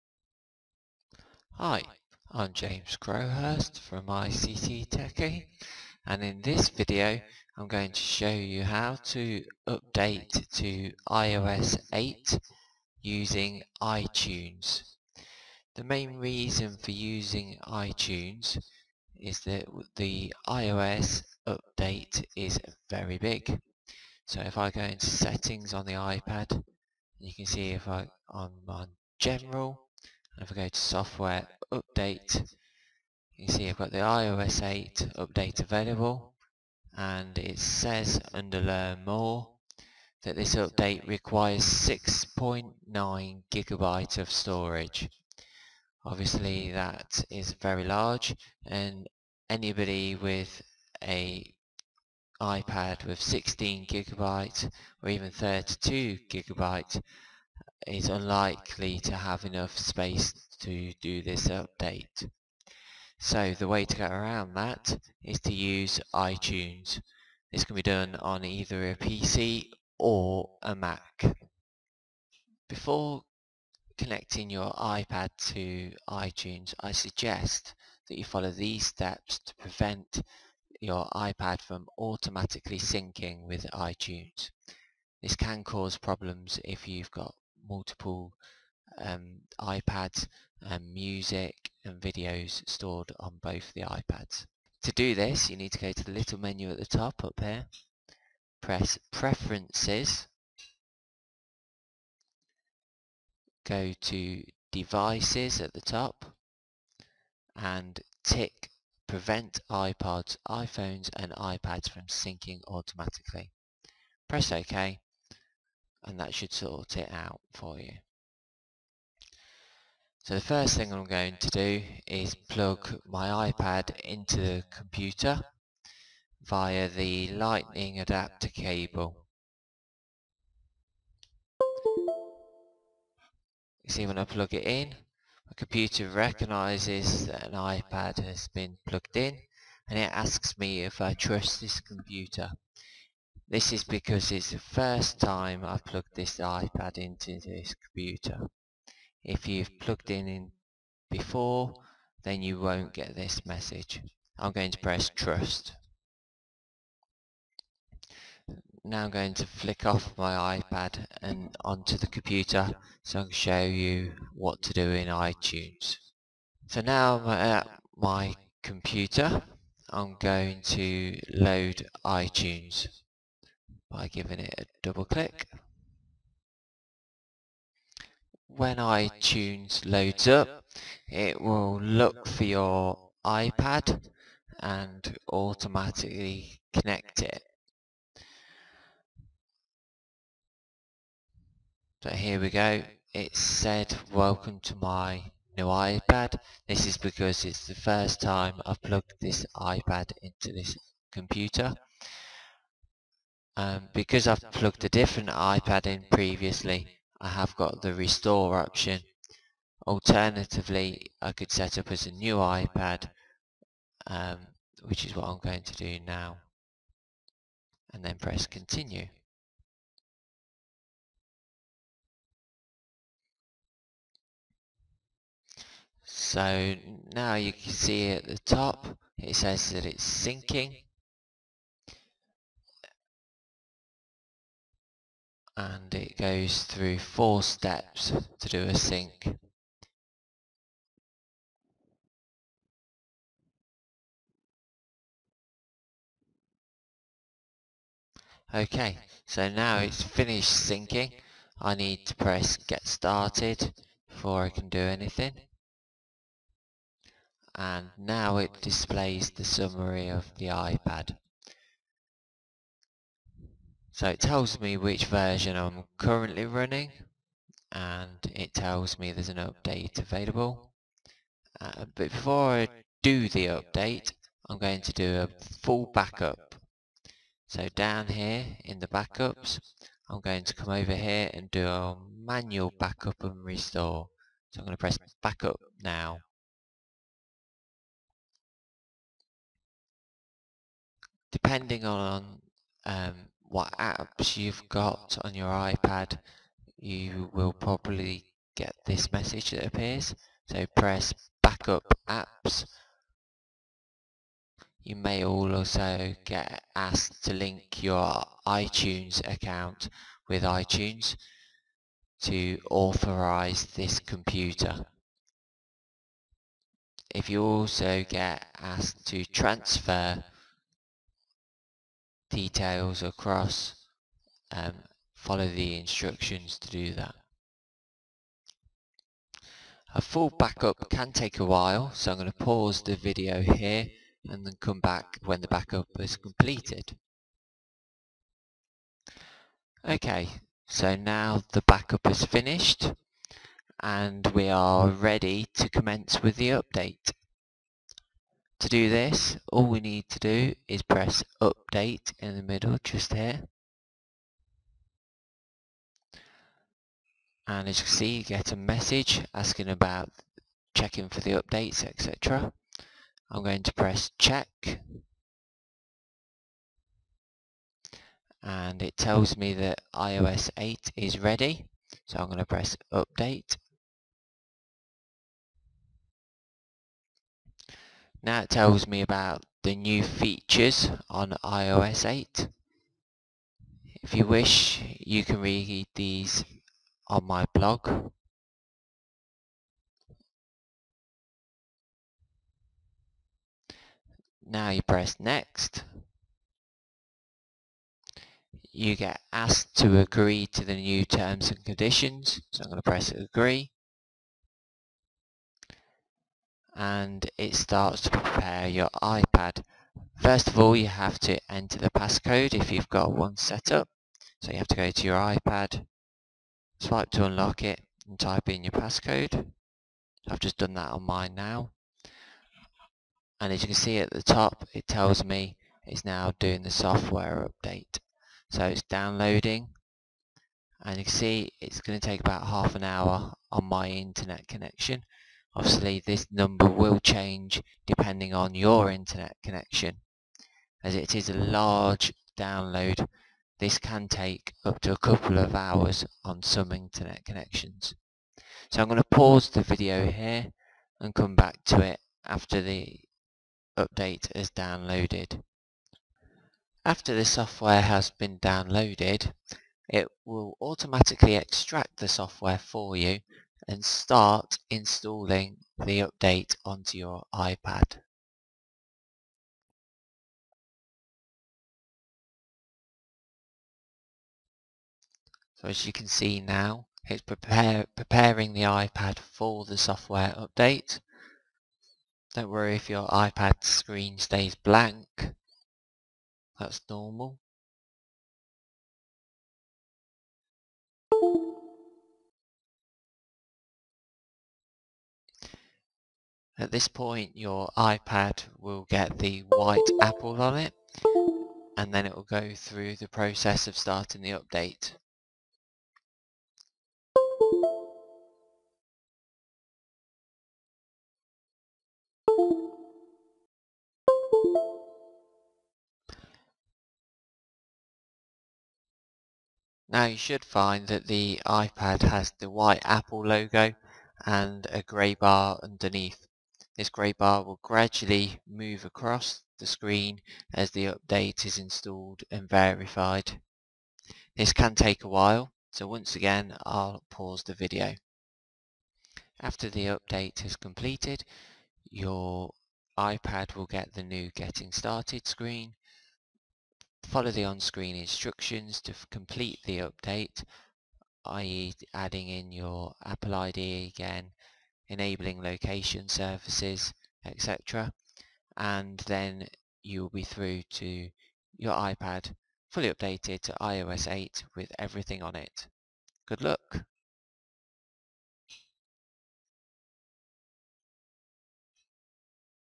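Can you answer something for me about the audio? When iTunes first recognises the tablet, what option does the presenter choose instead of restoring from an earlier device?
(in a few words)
Set up as a new iPad.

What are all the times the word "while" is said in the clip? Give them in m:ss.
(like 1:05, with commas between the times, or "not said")
5:31, 8:55.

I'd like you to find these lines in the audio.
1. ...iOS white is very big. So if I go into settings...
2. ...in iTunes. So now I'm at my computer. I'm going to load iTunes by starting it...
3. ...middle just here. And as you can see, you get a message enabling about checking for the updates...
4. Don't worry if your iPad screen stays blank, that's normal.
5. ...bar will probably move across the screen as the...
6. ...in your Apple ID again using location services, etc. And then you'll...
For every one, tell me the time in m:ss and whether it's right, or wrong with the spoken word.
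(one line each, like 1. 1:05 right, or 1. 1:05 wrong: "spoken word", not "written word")
1. 0:20 wrong: "update", not "white"
2. 2:44 wrong: "giving", not "starting"
3. 5:52 wrong: "asking", not "enabling"
4. 8:02 right
5. 8:47 wrong: "gradually", not "probably"
6. 9:12 wrong: "enabling", not "using".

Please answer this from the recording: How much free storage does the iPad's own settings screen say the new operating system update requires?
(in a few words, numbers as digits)
6.9 gigabytes.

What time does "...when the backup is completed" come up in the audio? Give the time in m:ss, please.
5:35.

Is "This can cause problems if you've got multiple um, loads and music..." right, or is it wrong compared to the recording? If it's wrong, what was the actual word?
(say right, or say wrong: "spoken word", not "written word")
wrong: "iPads", not "loads".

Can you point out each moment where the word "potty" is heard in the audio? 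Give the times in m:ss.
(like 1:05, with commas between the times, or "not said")
not said.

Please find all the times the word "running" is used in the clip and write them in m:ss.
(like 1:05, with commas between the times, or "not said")
4:26.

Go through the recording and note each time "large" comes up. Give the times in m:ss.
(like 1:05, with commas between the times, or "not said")
0:47, 7:21.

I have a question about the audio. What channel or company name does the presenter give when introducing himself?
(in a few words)
ICT Techie.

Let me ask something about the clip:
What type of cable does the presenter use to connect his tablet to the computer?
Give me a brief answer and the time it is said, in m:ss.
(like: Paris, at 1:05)
Lightning adapter cable, at 2:07.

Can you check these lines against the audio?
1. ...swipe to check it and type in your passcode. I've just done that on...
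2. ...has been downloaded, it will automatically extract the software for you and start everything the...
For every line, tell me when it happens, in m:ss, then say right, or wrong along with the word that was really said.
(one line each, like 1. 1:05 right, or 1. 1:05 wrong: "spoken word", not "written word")
1. 6:56 wrong: "unlock", not "check"
2. 7:37 wrong: "installing", not "everything".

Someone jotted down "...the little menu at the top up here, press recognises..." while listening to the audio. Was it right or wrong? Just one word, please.
wrong.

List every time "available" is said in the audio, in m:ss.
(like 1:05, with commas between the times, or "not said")
0:35, 4:29.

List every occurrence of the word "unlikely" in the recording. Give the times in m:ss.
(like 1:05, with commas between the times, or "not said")
0:58.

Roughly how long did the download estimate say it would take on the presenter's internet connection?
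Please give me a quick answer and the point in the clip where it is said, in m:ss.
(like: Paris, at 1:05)
Half an hour, at 7:12.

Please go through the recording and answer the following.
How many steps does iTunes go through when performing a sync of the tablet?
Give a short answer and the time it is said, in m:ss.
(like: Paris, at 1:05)
4, at 3:56.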